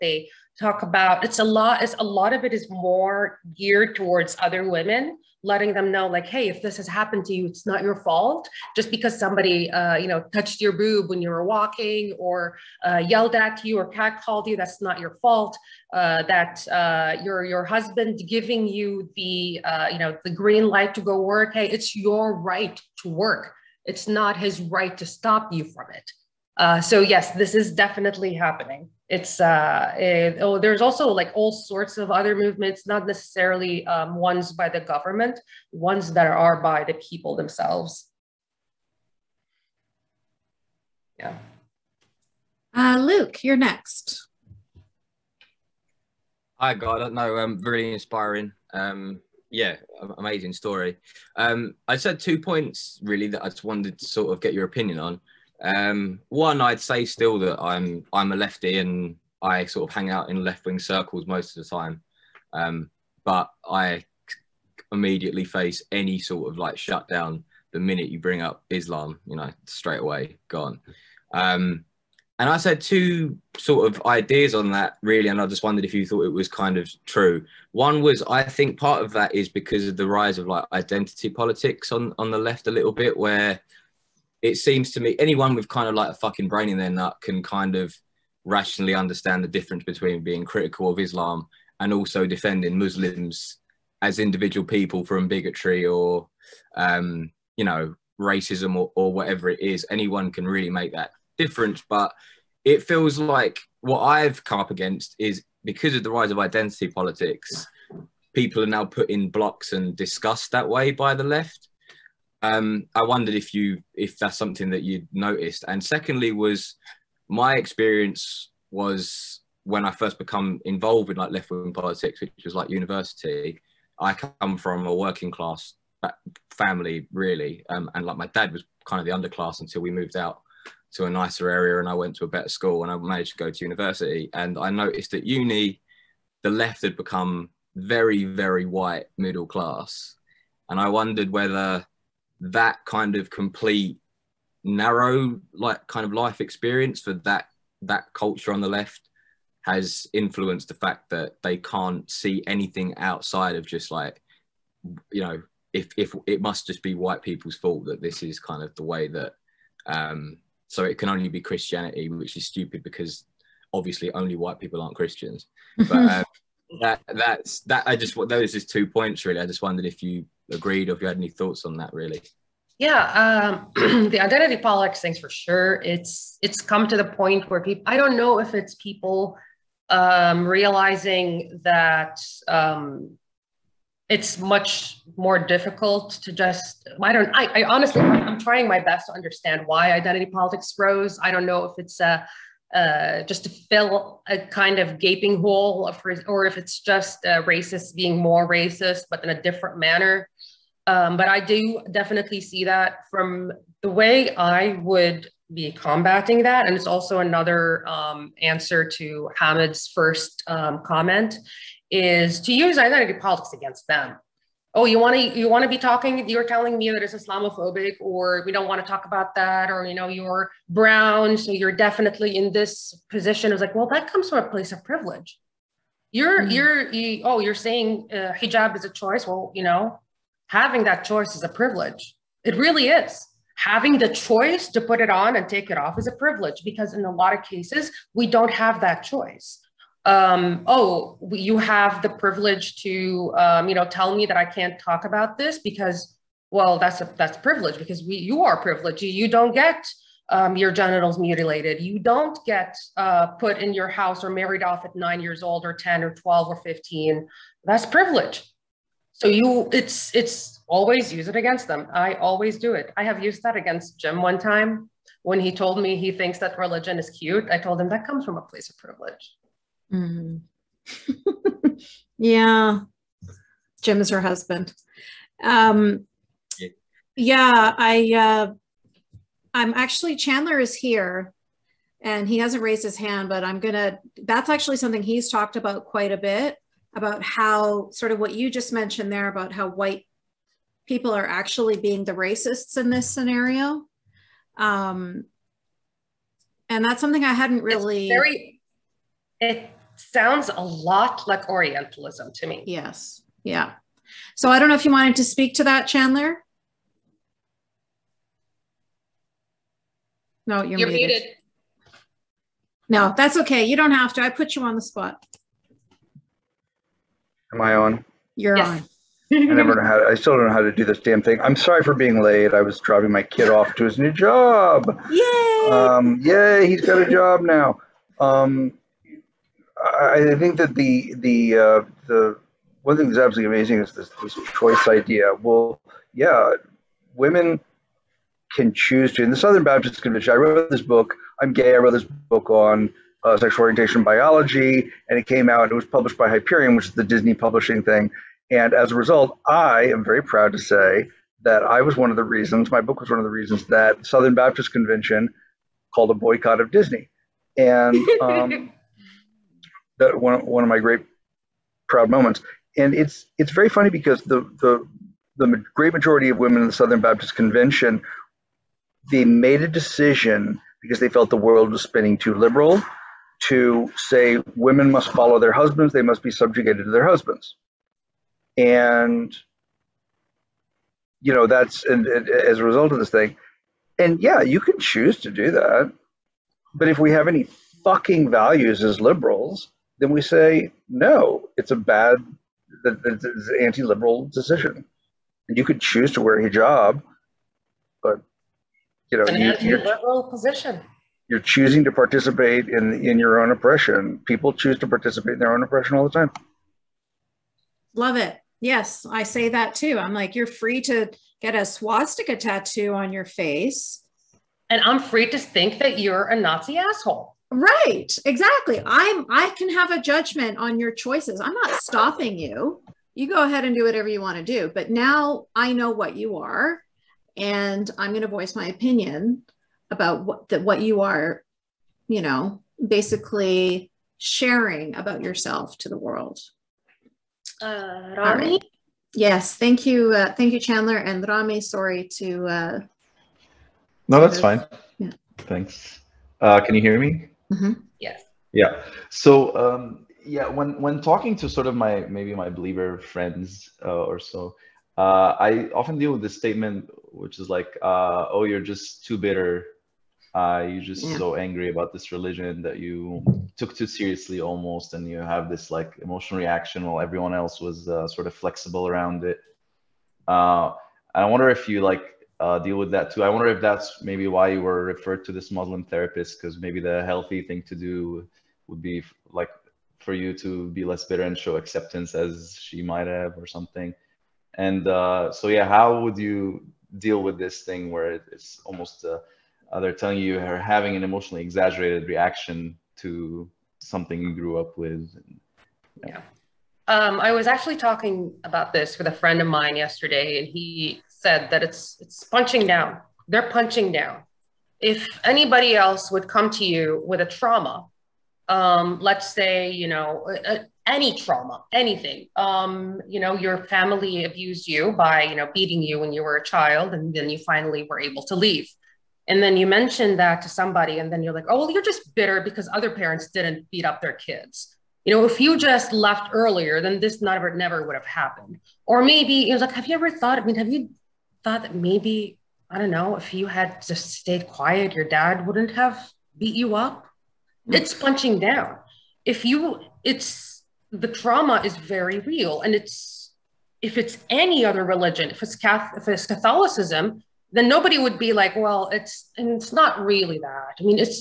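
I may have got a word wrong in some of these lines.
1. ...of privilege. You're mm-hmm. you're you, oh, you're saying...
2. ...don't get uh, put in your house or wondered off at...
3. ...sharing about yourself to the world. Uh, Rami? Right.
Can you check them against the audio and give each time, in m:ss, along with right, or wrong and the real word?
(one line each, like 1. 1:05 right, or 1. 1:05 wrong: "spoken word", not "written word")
1. 3:44 right
2. 4:11 wrong: "married", not "wondered"
3. 7:14 right.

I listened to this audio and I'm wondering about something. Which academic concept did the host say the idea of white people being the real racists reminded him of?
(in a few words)
Orientalism.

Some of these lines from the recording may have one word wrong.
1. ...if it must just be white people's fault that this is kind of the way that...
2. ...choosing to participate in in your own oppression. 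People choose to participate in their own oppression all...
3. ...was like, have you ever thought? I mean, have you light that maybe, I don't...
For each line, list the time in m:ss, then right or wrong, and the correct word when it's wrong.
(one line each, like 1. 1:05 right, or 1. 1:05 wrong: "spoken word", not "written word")
1. 2:35 right
2. 6:41 right
3. 8:49 wrong: "thought", not "light".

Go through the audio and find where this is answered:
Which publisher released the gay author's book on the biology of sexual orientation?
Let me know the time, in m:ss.
5:46.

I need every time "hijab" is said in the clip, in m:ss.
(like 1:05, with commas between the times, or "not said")
3:48, 6:36.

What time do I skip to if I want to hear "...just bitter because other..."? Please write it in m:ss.
8:41.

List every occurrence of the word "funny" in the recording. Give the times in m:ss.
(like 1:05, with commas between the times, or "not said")
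6:03.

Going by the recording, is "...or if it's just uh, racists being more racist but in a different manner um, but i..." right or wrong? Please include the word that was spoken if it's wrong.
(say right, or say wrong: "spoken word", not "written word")
right.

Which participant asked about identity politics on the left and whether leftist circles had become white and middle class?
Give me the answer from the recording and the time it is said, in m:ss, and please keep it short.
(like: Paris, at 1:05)
Luke, at 0:42.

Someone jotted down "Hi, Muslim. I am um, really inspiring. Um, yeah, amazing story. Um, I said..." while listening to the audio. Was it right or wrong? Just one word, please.
wrong.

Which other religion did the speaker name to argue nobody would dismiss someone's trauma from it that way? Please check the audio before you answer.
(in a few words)
Catholicism.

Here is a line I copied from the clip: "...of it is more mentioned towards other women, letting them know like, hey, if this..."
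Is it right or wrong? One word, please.
wrong.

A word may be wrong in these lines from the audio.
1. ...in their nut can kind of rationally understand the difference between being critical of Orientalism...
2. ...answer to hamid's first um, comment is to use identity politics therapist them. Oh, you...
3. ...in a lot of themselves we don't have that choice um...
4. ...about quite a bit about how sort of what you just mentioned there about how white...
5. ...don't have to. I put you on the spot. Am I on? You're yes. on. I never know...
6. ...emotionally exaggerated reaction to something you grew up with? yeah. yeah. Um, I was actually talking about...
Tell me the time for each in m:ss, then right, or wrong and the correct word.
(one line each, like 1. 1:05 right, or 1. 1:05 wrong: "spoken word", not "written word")
1. 1:26 wrong: "Islam", not "Orientalism"
2. 3:28 wrong: "against", not "therapist"
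3. 3:56 wrong: "cases", not "themselves"
4. 4:45 right
5. 5:13 right
6. 8:11 right.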